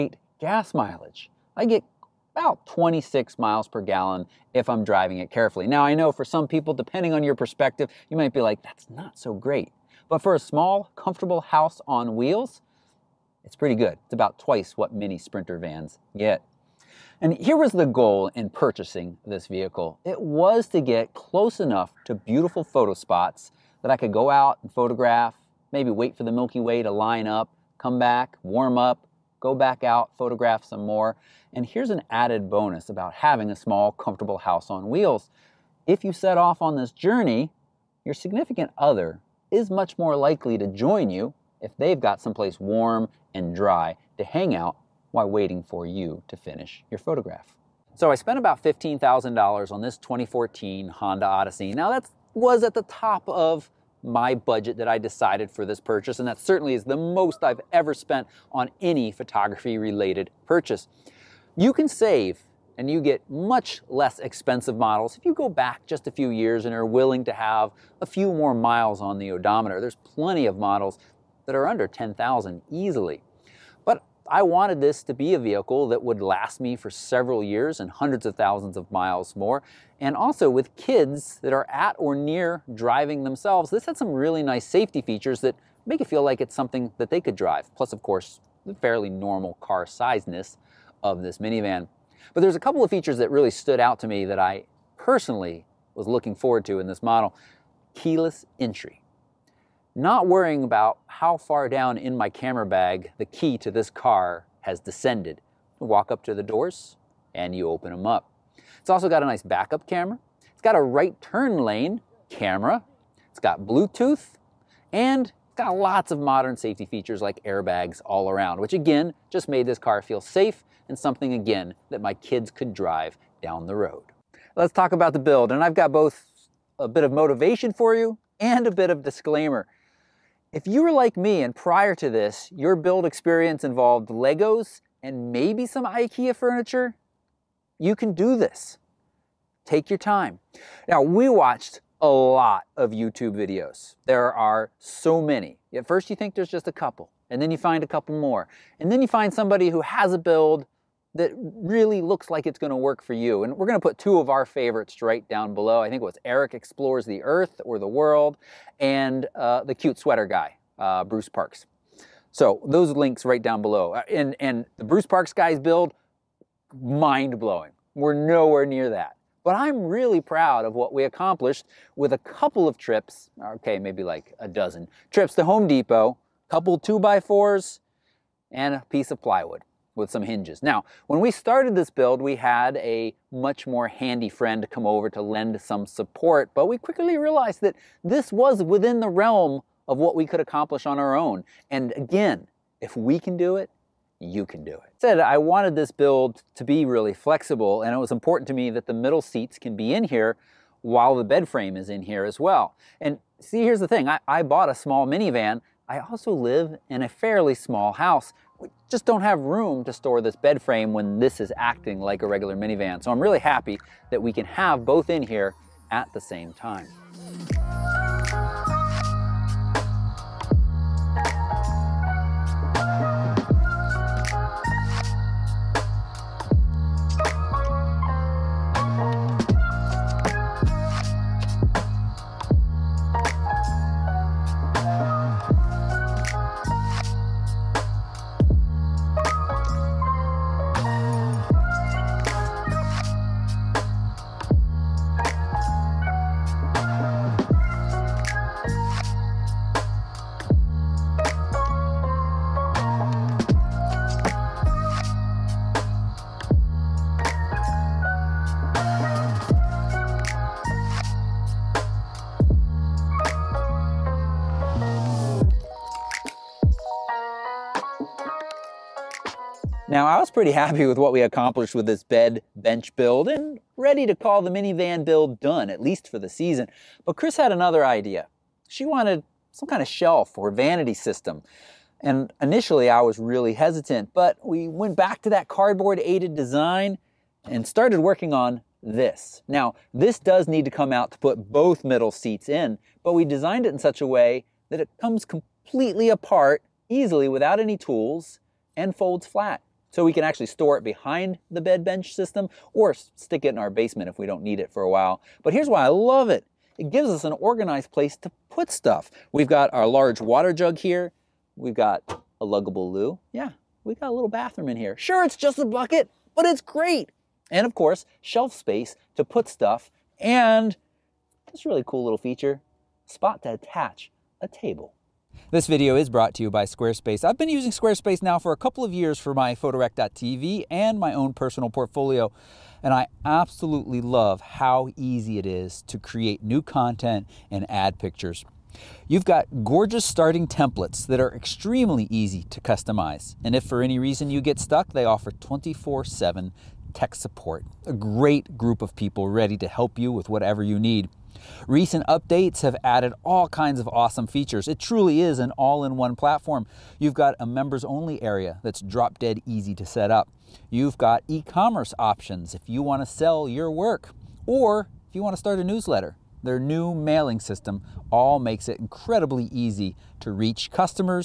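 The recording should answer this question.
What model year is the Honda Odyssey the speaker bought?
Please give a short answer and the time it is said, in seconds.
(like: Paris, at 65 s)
2014, at 49 s.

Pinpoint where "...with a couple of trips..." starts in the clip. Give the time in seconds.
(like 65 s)
171 s.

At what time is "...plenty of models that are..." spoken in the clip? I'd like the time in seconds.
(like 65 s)
69 s.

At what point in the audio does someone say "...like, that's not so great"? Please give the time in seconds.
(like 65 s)
8 s.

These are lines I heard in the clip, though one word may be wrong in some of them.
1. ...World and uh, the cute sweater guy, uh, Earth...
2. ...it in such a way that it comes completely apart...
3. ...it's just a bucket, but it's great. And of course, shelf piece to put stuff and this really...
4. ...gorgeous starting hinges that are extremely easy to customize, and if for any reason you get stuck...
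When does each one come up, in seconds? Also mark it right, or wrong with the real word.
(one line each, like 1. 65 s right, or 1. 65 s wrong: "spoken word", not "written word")
1. 157 s wrong: "Bruce", not "Earth"
2. 293 s right
3. 315 s wrong: "space", not "piece"
4. 339 s wrong: "templates", not "hinges".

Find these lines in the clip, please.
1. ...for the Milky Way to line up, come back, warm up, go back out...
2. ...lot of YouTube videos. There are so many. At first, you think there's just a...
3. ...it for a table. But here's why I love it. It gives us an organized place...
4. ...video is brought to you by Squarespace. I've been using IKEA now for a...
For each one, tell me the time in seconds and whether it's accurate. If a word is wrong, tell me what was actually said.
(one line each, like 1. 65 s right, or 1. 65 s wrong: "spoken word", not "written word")
1. 26 s right
2. 142 s right
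3. 304 s wrong: "while", not "table"
4. 325 s wrong: "Squarespace", not "IKEA".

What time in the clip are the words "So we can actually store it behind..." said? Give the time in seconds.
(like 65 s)
299 s.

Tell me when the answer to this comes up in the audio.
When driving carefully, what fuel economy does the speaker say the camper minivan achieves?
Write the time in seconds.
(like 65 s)
2 s.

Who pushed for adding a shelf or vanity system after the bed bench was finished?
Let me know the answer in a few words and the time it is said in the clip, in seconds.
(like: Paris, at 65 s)
Chris, at 277 s.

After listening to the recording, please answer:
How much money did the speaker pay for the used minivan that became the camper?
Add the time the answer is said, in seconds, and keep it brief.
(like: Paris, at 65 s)
$15,000, at 48 s.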